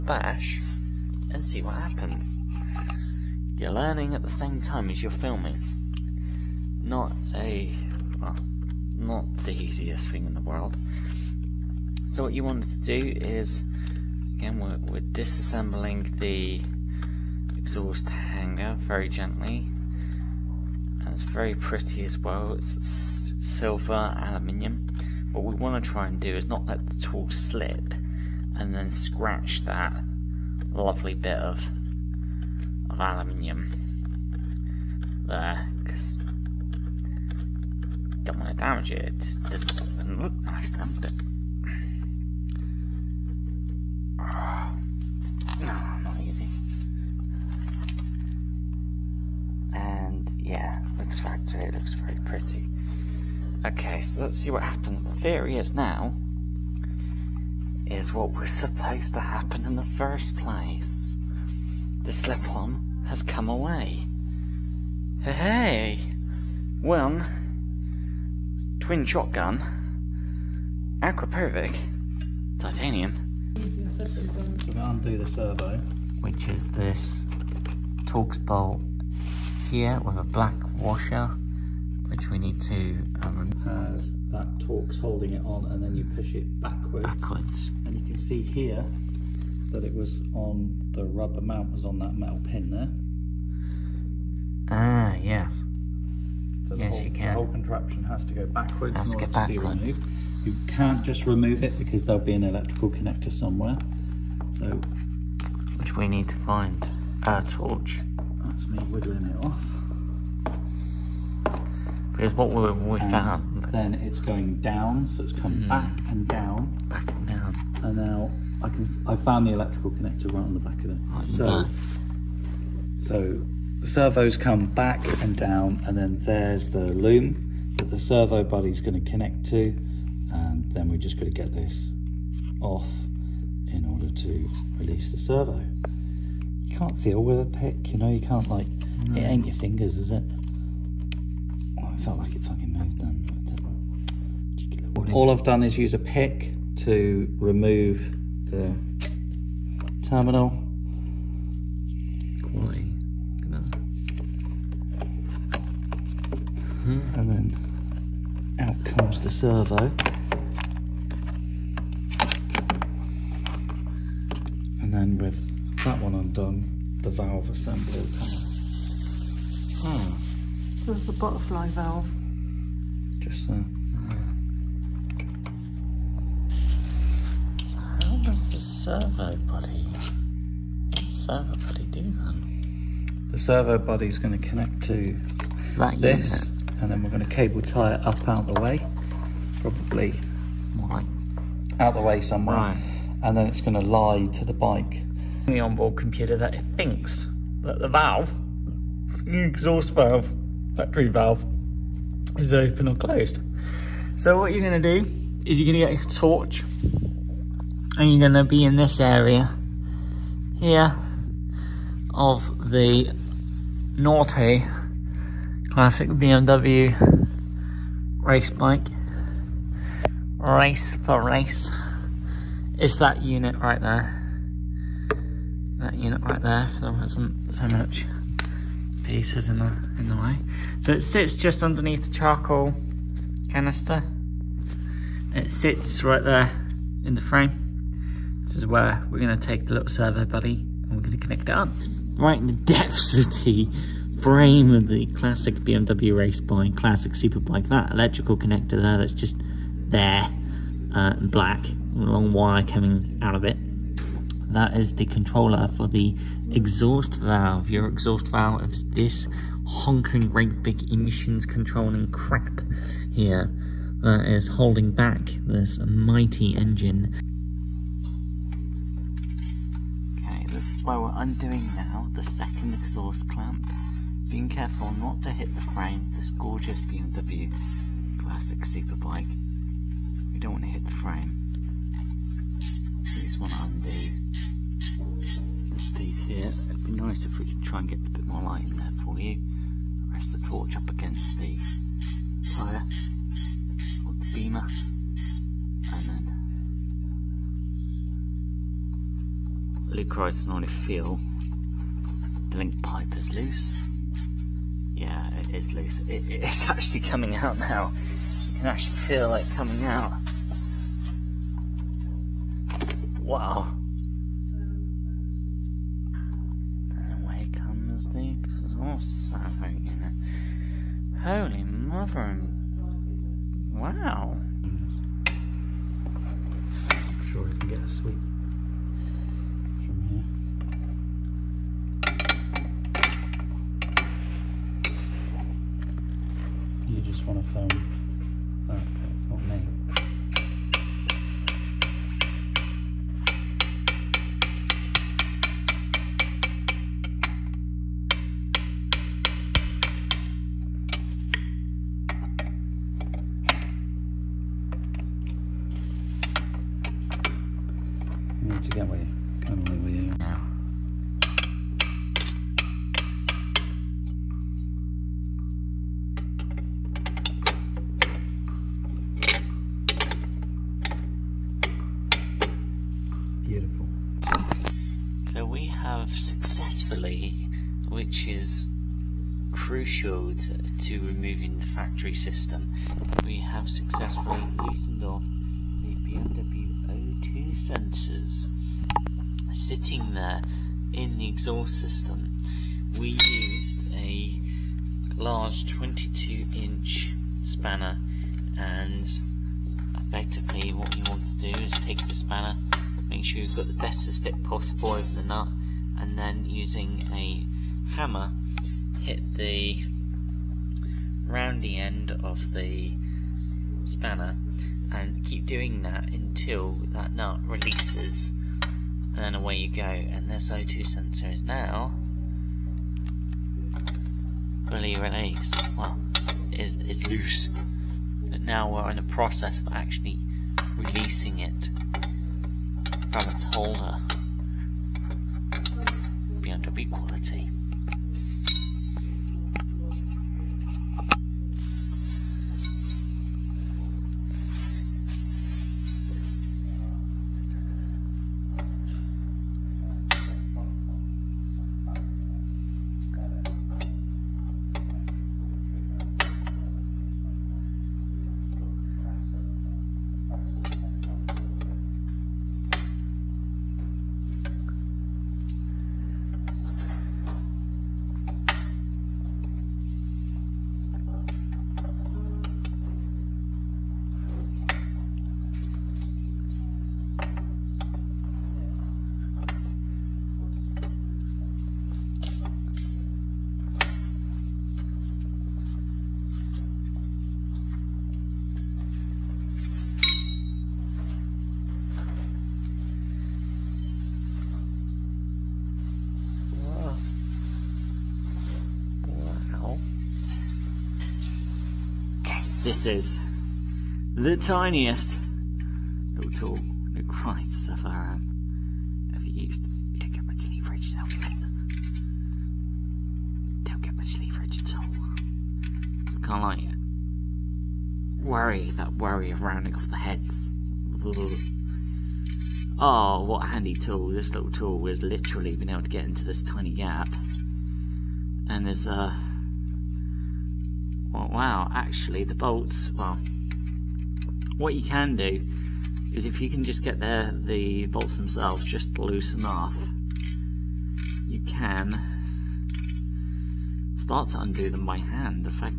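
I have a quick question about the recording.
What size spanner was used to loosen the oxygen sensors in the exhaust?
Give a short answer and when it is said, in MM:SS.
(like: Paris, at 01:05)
22 inch, at 06:35.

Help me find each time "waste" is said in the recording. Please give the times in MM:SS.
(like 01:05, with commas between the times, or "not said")
not said.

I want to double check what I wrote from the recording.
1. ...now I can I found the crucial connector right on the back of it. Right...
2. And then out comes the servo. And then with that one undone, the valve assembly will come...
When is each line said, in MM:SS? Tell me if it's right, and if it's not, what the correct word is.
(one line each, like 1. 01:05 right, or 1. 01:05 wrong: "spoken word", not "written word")
1. 01:57 wrong: "electrical", not "crucial"
2. 02:36 right.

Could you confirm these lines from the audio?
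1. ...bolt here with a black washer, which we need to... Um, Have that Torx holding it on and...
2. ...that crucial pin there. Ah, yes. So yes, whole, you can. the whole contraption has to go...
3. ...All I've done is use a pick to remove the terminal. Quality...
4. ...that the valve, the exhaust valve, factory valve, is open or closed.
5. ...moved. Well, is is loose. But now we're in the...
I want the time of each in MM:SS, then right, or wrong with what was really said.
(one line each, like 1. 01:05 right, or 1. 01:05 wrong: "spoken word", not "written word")
1. 01:18 wrong: "Has", not "Have"
2. 01:31 wrong: "metal", not "crucial"
3. 02:25 right
4. 03:17 right
5. 07:04 wrong: "released", not "moved".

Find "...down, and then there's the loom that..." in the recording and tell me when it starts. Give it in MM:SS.
02:05.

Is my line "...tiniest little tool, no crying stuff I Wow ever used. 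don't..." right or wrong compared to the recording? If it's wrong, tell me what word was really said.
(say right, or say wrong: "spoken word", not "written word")
wrong: "Have", not "Wow".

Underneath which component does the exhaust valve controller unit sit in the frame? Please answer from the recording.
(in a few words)
Charcoal canister.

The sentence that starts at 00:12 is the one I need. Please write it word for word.
So what you want to do is Again, we're, we're disassembling the exhaust hanger very gently.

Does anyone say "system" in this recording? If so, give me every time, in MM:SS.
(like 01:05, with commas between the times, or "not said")
06:22, 06:31.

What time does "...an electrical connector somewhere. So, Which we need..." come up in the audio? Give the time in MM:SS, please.
01:42.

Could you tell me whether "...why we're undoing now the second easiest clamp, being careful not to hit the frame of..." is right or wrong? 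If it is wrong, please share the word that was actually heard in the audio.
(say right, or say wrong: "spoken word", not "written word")
wrong: "exhaust", not "easiest".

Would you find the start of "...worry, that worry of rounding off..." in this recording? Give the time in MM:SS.
08:38.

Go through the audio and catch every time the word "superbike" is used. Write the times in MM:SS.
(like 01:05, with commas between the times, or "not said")
04:07, 04:38.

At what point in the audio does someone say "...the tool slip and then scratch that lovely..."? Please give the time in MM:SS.
00:26.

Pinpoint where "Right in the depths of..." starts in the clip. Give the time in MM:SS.
04:02.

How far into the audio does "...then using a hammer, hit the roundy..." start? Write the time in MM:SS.
06:46.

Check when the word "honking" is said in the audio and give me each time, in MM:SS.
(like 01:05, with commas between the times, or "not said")
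04:19.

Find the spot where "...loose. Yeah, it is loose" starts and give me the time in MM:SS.
05:03.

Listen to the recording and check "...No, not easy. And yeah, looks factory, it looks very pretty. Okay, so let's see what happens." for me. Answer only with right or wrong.
right.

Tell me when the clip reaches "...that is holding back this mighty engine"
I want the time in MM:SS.
04:24.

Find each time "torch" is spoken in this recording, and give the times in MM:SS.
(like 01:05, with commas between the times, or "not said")
01:47, 03:26, 04:50.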